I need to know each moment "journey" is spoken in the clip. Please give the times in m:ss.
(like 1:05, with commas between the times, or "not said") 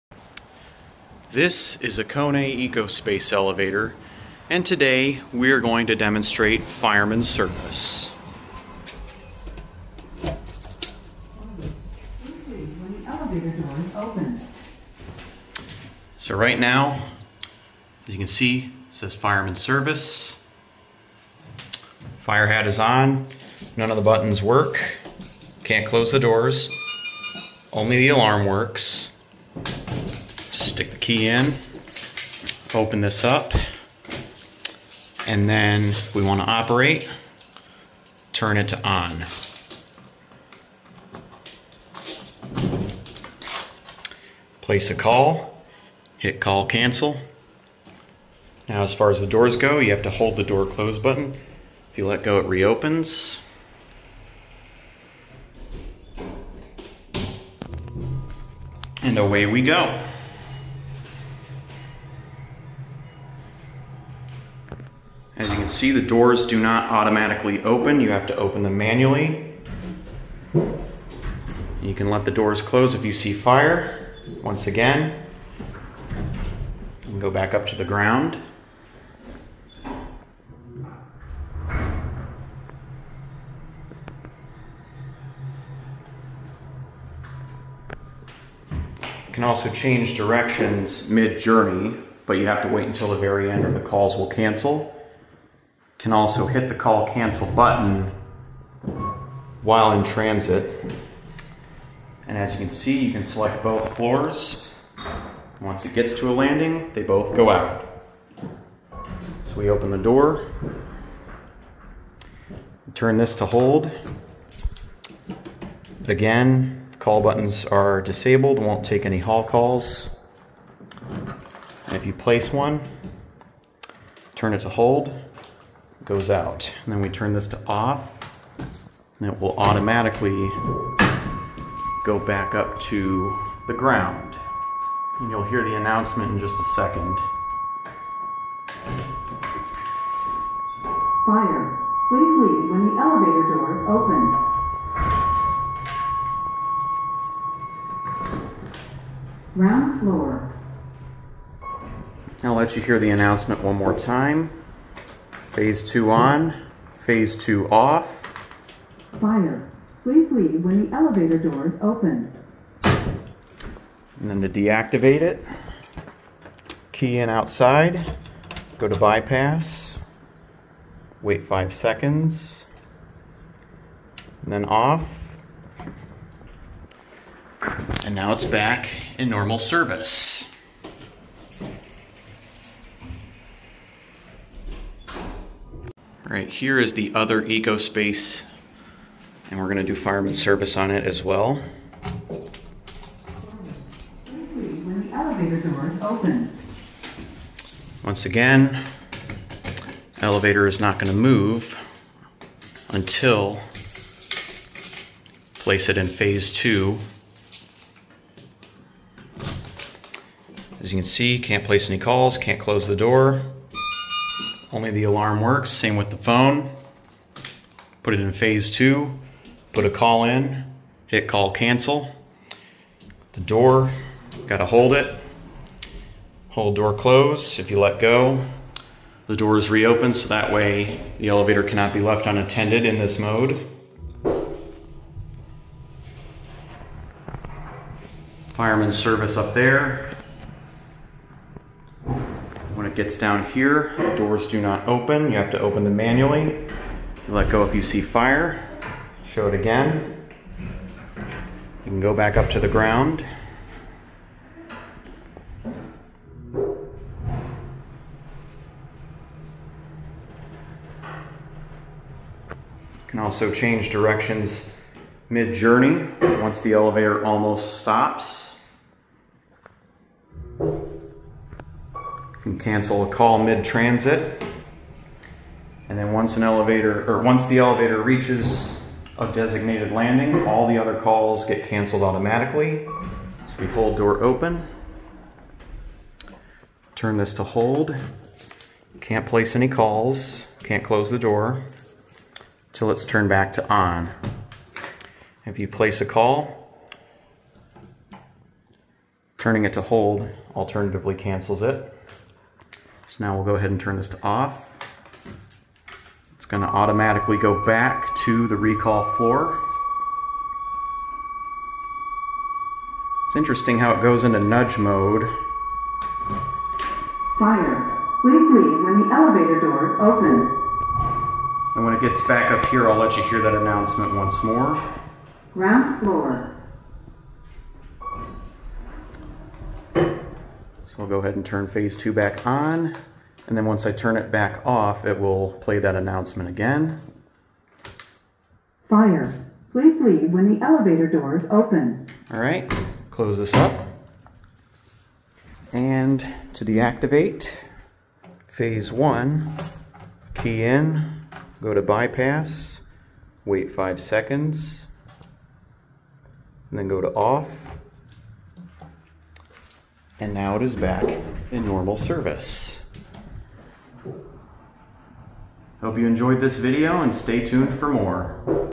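1:31, 4:25.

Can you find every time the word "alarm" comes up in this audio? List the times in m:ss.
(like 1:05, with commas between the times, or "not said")
0:28, 3:35.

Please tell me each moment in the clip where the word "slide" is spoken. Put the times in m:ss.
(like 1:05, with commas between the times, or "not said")
not said.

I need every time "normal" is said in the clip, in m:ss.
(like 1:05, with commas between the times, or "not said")
2:59, 6:01.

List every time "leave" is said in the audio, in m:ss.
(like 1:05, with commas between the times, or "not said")
2:22, 2:40, 5:18, 5:40.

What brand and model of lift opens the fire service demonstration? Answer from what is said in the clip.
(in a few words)
Kone EcoSpace.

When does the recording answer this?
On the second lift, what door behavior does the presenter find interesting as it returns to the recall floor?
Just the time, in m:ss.
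5:14.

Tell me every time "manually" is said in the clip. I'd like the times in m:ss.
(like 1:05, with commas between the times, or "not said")
1:08, 4:05.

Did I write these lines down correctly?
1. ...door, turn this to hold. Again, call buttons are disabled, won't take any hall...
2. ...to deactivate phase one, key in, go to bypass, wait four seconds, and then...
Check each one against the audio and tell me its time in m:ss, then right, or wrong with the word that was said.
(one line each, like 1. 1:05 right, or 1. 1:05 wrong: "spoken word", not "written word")
1. 1:49 right
2. 5:46 wrong: "five", not "four".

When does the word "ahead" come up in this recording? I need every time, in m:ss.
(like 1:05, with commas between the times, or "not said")
5:03, 5:31.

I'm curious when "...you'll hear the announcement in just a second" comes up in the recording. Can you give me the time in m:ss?
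2:15.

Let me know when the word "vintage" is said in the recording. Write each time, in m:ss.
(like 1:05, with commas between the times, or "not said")
not said.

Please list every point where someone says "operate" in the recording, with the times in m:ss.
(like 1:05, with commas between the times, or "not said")
0:36.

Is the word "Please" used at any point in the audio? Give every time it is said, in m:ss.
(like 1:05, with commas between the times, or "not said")
2:22, 2:40, 5:18, 5:39.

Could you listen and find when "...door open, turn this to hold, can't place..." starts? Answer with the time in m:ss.
4:43.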